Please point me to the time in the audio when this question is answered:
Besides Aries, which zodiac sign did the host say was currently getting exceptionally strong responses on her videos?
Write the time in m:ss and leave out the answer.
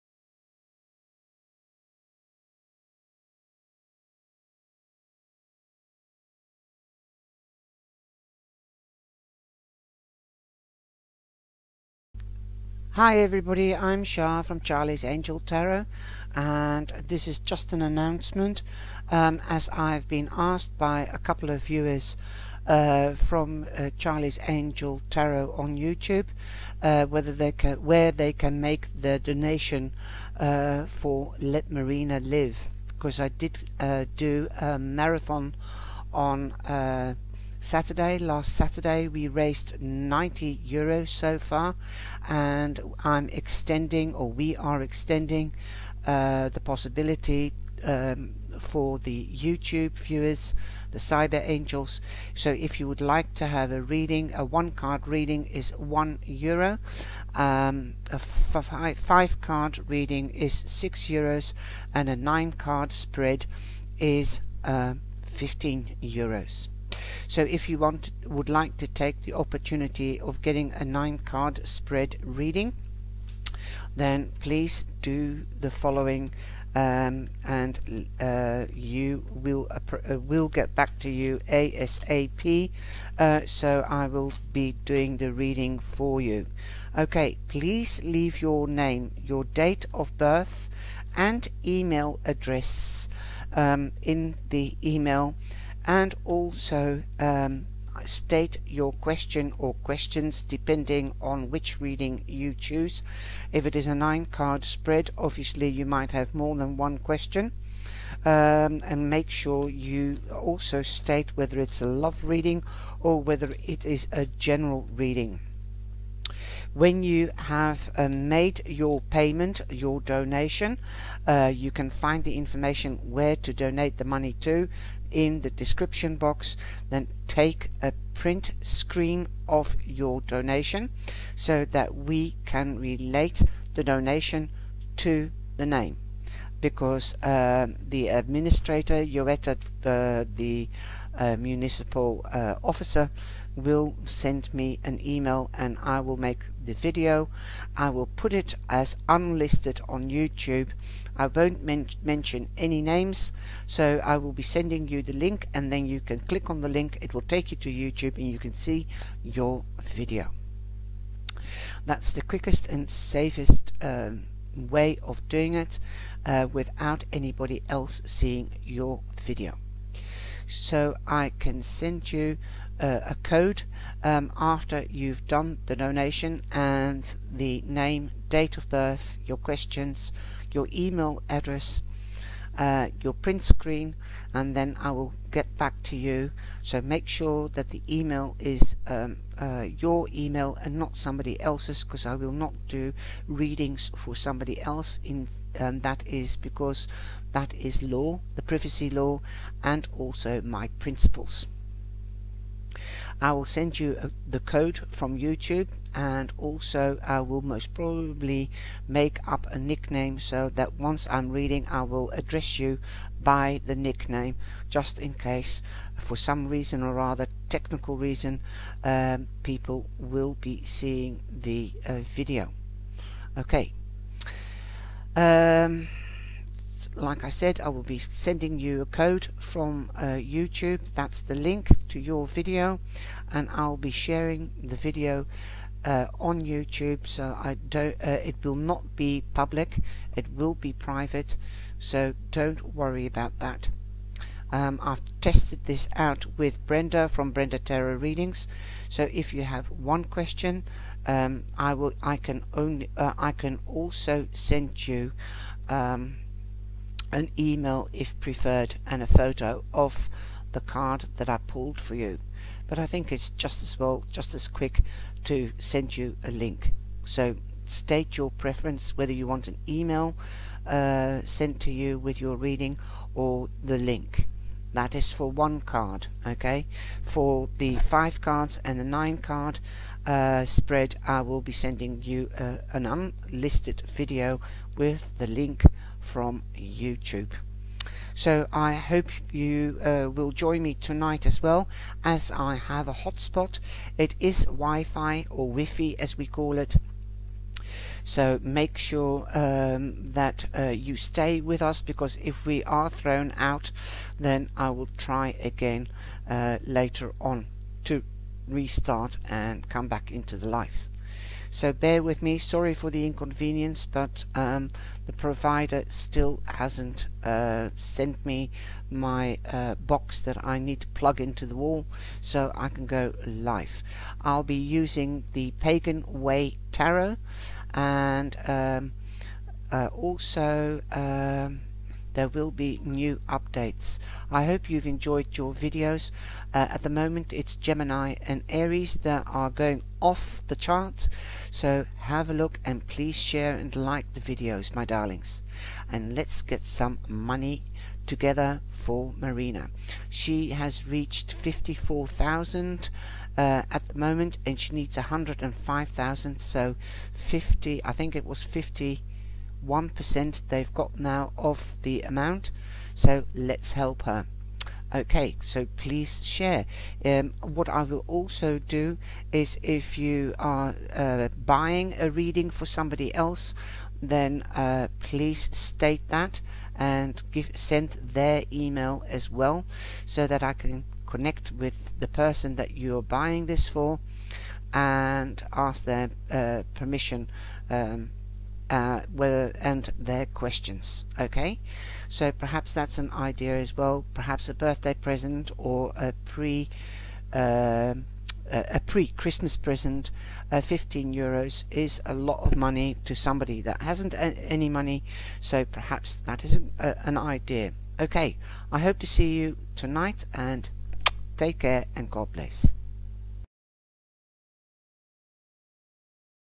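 5:37.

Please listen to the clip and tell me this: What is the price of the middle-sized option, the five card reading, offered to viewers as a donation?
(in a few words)
6 euros.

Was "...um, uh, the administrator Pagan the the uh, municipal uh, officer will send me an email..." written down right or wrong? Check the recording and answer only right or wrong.
wrong.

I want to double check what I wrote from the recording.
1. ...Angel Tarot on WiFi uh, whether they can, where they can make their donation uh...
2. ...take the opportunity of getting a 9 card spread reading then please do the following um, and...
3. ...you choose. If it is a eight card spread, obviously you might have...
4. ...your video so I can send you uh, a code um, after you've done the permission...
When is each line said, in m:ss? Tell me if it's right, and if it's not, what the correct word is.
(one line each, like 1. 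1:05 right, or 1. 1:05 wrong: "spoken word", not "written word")
1. 0:24 wrong: "YouTube", not "WiFi"
2. 1:08 right
3. 1:42 wrong: "nine", not "eight"
4. 2:48 wrong: "donation", not "permission".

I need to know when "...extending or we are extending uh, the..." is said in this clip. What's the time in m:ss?
0:43.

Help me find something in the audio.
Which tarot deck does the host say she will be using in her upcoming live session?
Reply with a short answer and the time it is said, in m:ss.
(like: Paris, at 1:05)
Pagan Way Tarot, at 5:25.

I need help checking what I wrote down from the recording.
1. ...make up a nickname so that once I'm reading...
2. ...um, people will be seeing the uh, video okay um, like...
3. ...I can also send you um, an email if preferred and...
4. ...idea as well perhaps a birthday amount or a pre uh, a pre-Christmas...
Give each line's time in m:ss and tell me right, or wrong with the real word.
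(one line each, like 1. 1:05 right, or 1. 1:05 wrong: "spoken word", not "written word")
1. 3:28 right
2. 3:38 right
3. 4:13 right
4. 6:33 wrong: "present", not "amount".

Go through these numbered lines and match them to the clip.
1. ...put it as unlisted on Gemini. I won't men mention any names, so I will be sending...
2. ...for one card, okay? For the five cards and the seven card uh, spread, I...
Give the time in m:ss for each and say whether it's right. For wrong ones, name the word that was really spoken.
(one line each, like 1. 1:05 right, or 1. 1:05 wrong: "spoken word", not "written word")
1. 2:28 wrong: "YouTube", not "Gemini"
2. 4:35 wrong: "nine", not "seven".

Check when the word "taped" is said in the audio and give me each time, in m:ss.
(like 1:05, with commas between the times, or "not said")
not said.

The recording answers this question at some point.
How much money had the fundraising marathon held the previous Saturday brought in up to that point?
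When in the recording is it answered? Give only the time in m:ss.
0:39.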